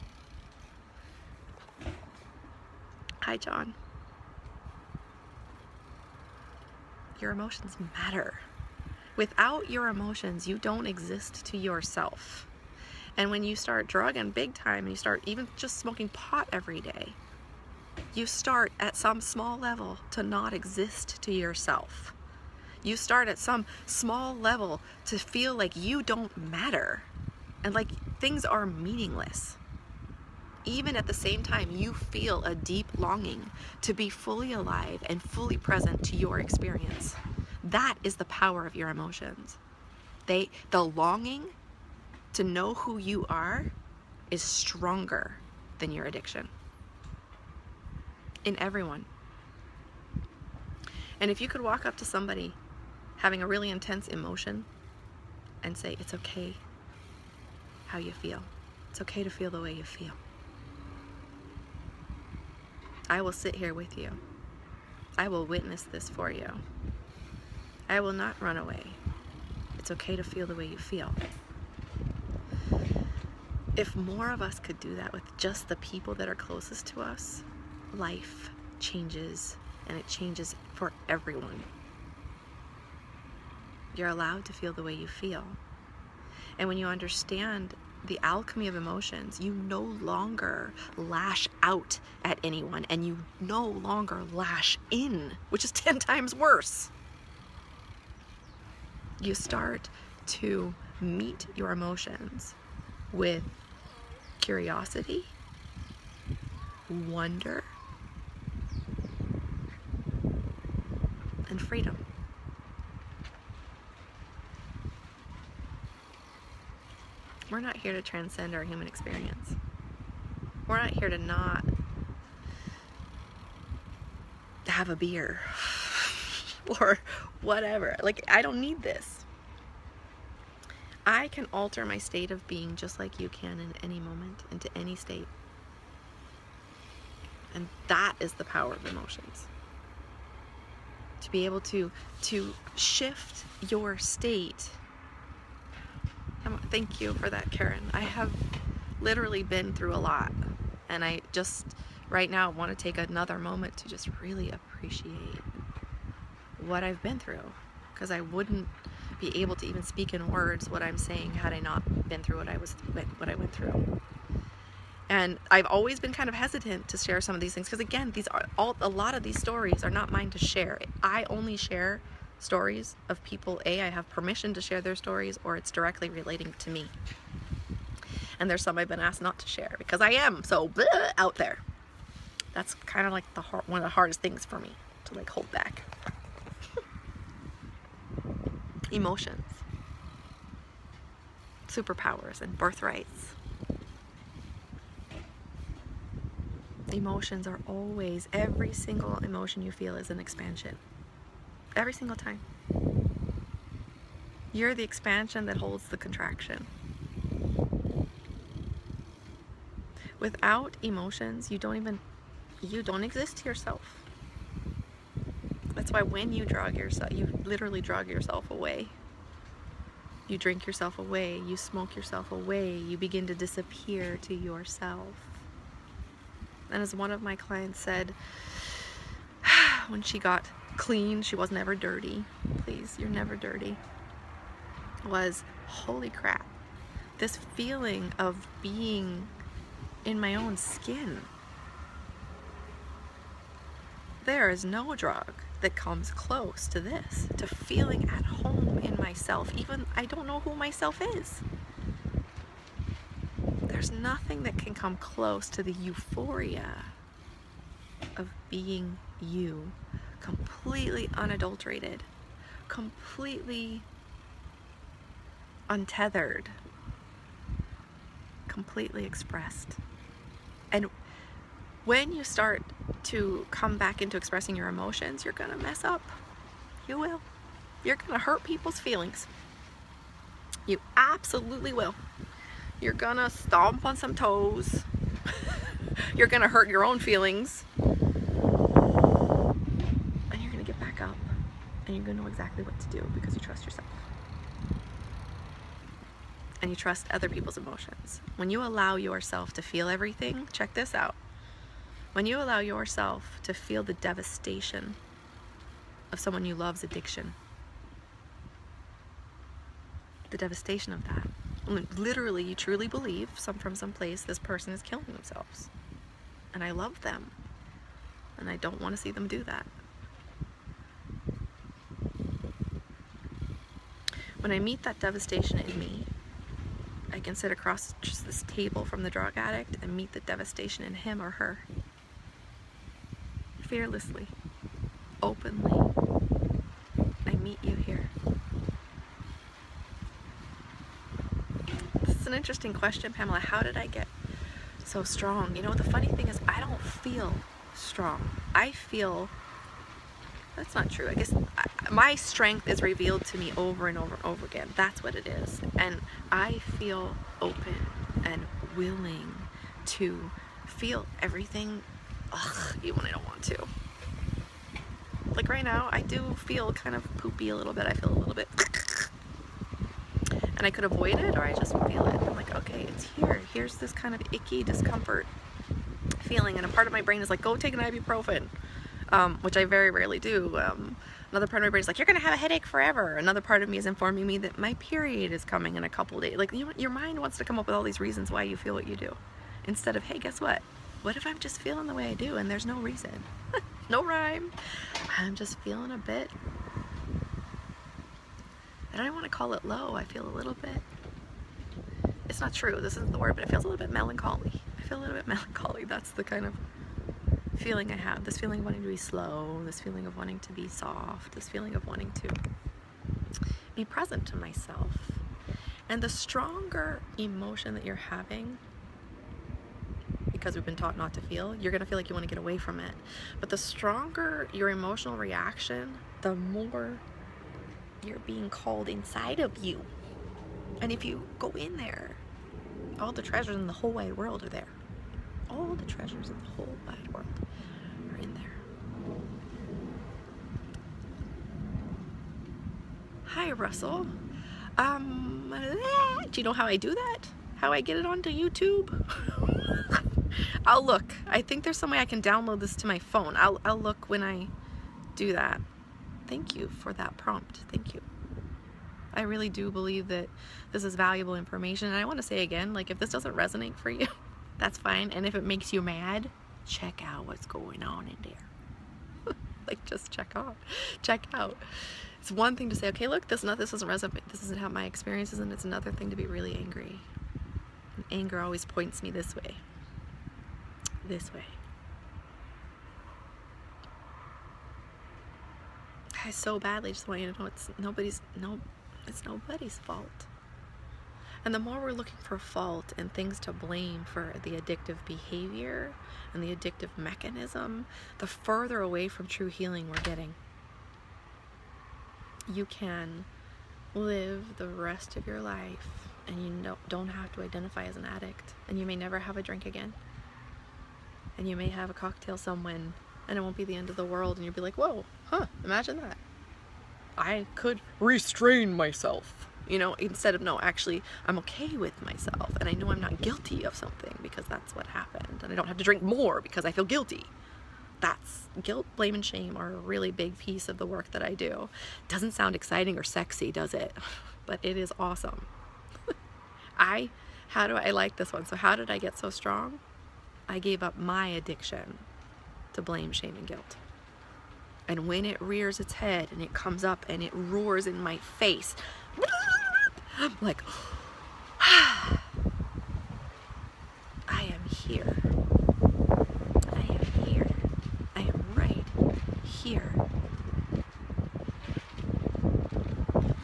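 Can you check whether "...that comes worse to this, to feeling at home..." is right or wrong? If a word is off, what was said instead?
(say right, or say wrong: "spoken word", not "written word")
wrong: "close", not "worse".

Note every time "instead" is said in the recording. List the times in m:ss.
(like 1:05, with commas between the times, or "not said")
6:29, 8:39.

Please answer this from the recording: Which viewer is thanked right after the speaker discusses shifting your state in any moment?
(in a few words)
Karen.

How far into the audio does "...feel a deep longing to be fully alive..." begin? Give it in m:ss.
0:31.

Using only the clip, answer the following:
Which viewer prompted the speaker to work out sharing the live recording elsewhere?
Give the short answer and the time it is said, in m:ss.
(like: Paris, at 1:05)
Russell, at 7:23.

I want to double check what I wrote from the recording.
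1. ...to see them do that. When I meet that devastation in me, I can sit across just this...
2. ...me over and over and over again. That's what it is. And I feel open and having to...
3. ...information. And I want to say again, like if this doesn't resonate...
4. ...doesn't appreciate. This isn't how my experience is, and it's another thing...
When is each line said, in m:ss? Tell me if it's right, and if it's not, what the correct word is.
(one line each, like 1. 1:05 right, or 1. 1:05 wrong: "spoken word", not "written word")
1. 5:18 right
2. 5:53 wrong: "willing", not "having"
3. 7:41 right
4. 7:53 wrong: "resonate", not "appreciate".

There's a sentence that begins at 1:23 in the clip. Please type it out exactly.
You're allowed to feel the way you feel.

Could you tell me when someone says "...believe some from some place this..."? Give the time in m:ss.
5:12.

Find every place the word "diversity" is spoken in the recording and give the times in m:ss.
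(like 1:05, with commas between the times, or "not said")
not said.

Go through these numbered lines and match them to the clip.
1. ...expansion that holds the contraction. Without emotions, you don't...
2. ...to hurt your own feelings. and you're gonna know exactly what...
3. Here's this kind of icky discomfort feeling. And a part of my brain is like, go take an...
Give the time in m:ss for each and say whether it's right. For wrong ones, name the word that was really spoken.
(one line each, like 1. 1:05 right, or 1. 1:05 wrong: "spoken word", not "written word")
1. 3:24 right
2. 4:46 right
3. 6:13 right.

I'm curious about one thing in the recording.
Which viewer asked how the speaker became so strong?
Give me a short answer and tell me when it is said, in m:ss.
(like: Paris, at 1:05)
Pamela, at 5:43.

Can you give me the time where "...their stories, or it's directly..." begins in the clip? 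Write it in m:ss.
2:54.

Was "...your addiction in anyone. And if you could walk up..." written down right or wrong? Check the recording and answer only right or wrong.
wrong.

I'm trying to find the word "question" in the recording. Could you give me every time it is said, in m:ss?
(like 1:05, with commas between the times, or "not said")
5:42.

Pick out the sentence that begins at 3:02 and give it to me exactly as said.
That's kind of like the hard, one of the hardest things for me to like hold back.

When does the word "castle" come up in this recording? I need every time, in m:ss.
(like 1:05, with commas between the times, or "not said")
not said.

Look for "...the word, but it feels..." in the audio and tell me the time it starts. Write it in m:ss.
6:43.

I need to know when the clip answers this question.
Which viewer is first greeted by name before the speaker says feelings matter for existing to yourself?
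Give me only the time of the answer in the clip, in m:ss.
0:03.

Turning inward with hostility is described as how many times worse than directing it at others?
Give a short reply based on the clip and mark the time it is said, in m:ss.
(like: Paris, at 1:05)
10, at 1:35.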